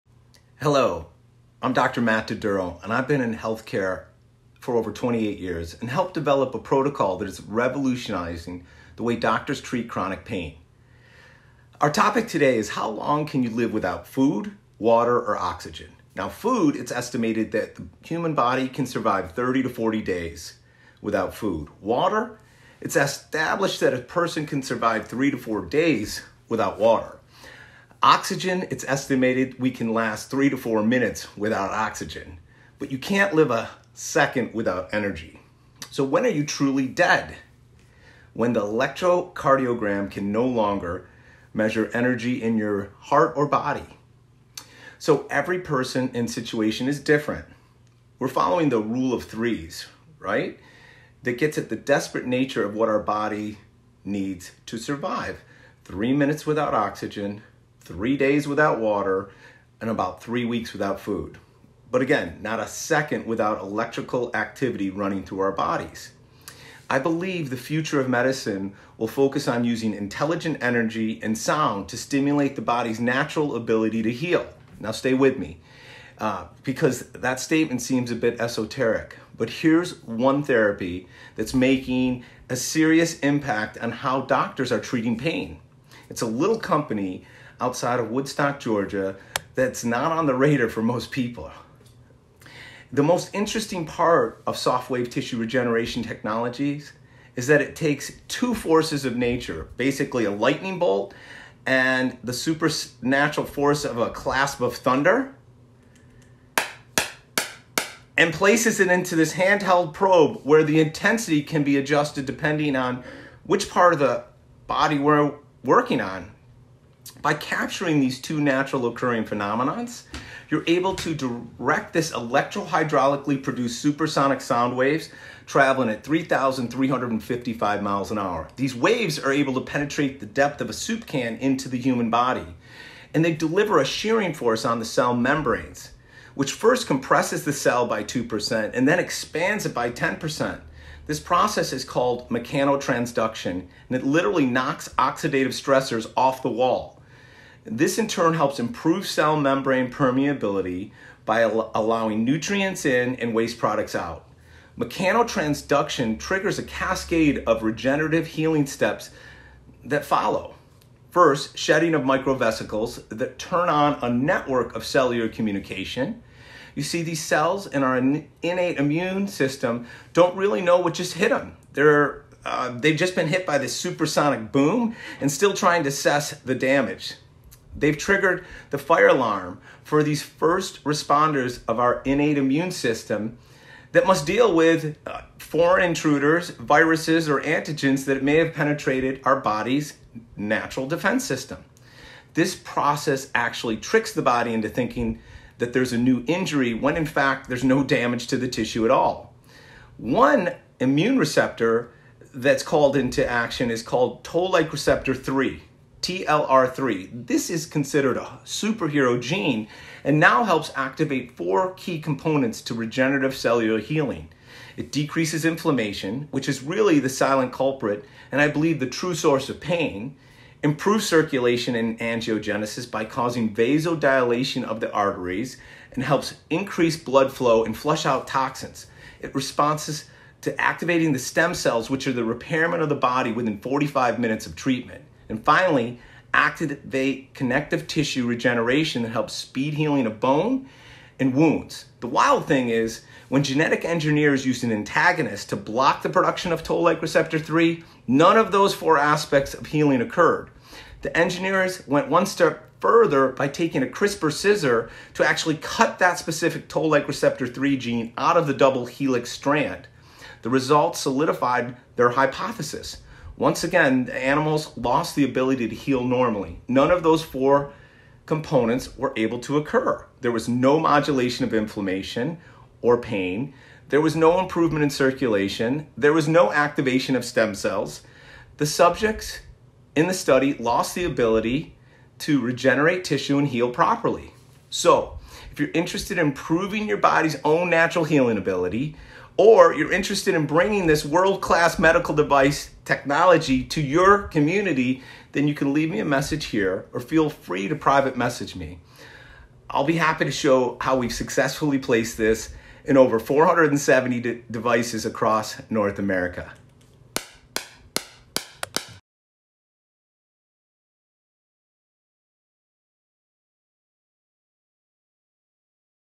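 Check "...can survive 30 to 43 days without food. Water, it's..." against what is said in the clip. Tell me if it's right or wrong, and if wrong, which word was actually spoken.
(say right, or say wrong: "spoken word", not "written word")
wrong: "40", not "43".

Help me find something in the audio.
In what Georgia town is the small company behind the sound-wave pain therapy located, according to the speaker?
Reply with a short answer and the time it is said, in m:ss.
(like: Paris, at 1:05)
Woodstock, at 1:28.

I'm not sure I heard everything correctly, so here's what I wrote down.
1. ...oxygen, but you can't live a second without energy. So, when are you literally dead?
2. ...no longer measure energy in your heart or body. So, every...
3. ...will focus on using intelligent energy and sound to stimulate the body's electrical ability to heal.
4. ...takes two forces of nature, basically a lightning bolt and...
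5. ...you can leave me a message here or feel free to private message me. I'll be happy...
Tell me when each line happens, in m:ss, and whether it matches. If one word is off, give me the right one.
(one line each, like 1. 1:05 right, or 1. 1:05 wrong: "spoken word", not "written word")
1. 0:31 wrong: "truly", not "literally"
2. 0:40 right
3. 1:08 wrong: "natural", not "electrical"
4. 1:37 right
5. 4:55 right.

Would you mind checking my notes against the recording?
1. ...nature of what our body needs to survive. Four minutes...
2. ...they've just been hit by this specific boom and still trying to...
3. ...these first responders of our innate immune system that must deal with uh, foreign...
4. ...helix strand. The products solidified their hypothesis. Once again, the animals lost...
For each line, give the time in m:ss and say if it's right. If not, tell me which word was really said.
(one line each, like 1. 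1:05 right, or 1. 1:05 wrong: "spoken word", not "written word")
1. 0:52 wrong: "Three", not "Four"
2. 2:52 wrong: "supersonic", not "specific"
3. 3:00 right
4. 4:18 wrong: "results", not "products".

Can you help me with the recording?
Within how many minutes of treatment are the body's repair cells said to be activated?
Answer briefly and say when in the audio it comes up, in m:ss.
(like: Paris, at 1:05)
45 minutes, at 3:53.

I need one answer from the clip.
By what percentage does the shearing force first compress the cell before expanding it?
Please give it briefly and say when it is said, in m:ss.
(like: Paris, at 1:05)
2%, at 2:18.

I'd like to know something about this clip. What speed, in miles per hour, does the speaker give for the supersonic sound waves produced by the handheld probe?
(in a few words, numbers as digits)
3,355 miles an hour.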